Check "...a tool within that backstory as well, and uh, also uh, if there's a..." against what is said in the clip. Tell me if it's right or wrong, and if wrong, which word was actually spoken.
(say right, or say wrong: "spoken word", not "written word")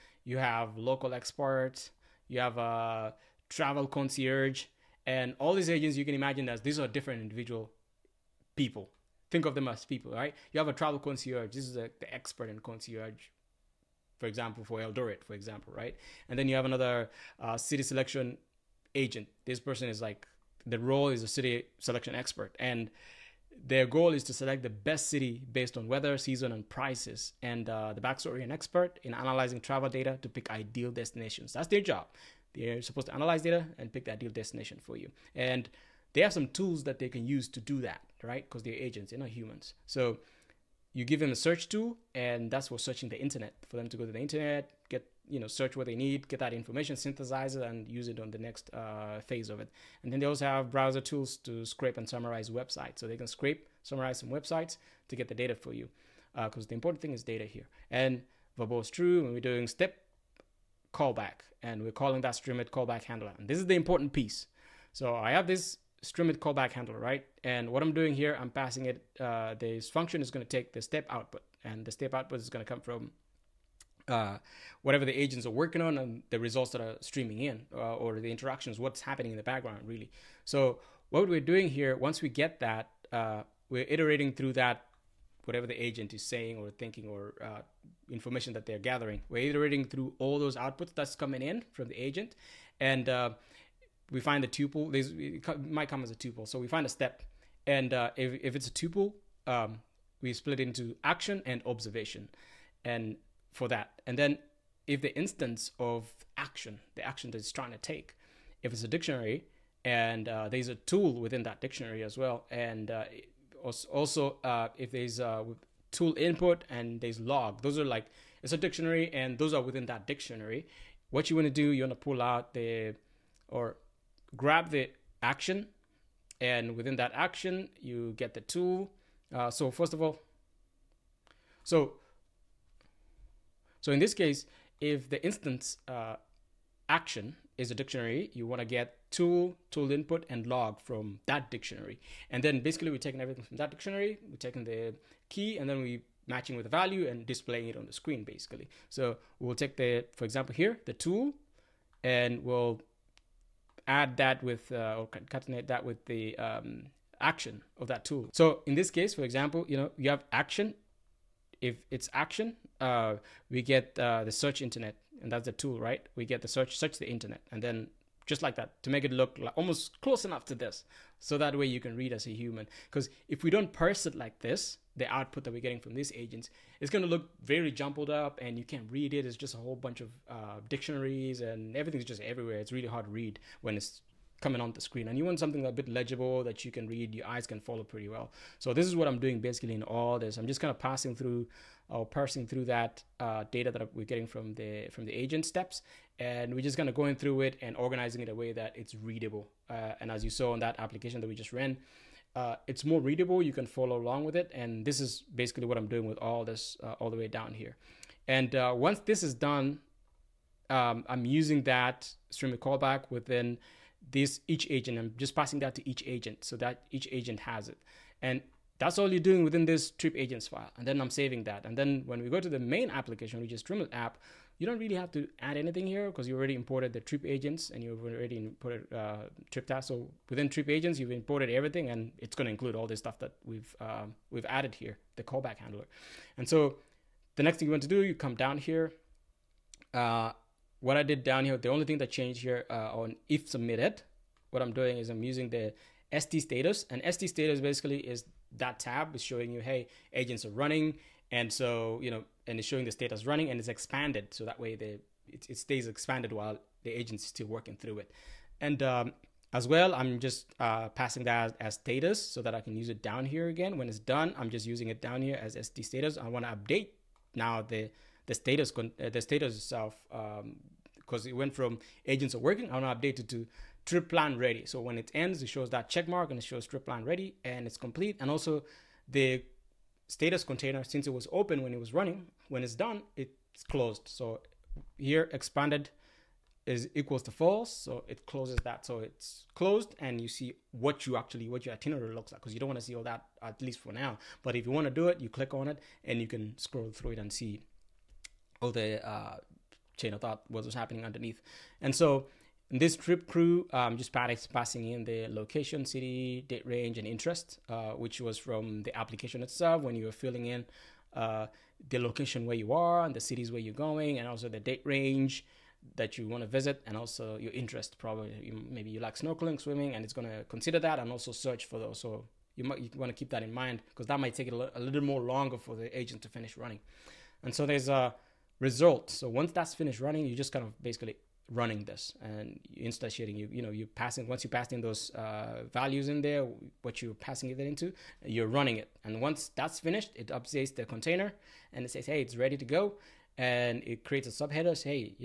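wrong: "dictionary", not "backstory".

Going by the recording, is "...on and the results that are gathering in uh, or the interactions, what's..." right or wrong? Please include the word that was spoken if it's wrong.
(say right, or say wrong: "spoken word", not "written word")
wrong: "streaming", not "gathering".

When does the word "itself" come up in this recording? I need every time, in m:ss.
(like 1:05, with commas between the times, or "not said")
4:29, 5:09.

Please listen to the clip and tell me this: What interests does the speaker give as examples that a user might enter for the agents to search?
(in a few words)
snorkeling, swimming.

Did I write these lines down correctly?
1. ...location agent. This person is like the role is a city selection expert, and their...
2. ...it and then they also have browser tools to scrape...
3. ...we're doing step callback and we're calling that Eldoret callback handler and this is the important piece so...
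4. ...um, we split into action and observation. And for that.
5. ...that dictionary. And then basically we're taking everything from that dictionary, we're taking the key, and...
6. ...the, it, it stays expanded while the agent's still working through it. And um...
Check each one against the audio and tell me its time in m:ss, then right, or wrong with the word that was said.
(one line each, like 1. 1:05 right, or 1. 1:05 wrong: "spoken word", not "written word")
1. 0:17 wrong: "selection", not "location"
2. 0:49 right
3. 0:59 wrong: "Streamlit", not "Eldoret"
4. 1:39 right
5. 2:21 right
6. 4:14 right.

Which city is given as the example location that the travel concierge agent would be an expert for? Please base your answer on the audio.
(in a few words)
Eldoret.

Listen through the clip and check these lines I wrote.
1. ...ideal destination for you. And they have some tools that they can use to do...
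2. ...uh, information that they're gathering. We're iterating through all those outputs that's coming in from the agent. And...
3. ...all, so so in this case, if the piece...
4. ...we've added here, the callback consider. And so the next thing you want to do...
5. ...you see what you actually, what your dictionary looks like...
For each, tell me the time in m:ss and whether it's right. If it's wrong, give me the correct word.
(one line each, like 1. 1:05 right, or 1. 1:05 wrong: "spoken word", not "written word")
1. 0:34 right
2. 1:27 right
3. 2:10 wrong: "instance", not "piece"
4. 3:54 wrong: "handler", not "consider"
5. 4:50 wrong: "itinerary", not "dictionary".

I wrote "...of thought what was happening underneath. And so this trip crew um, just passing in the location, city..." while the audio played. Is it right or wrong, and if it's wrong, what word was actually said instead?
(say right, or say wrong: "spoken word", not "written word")
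right.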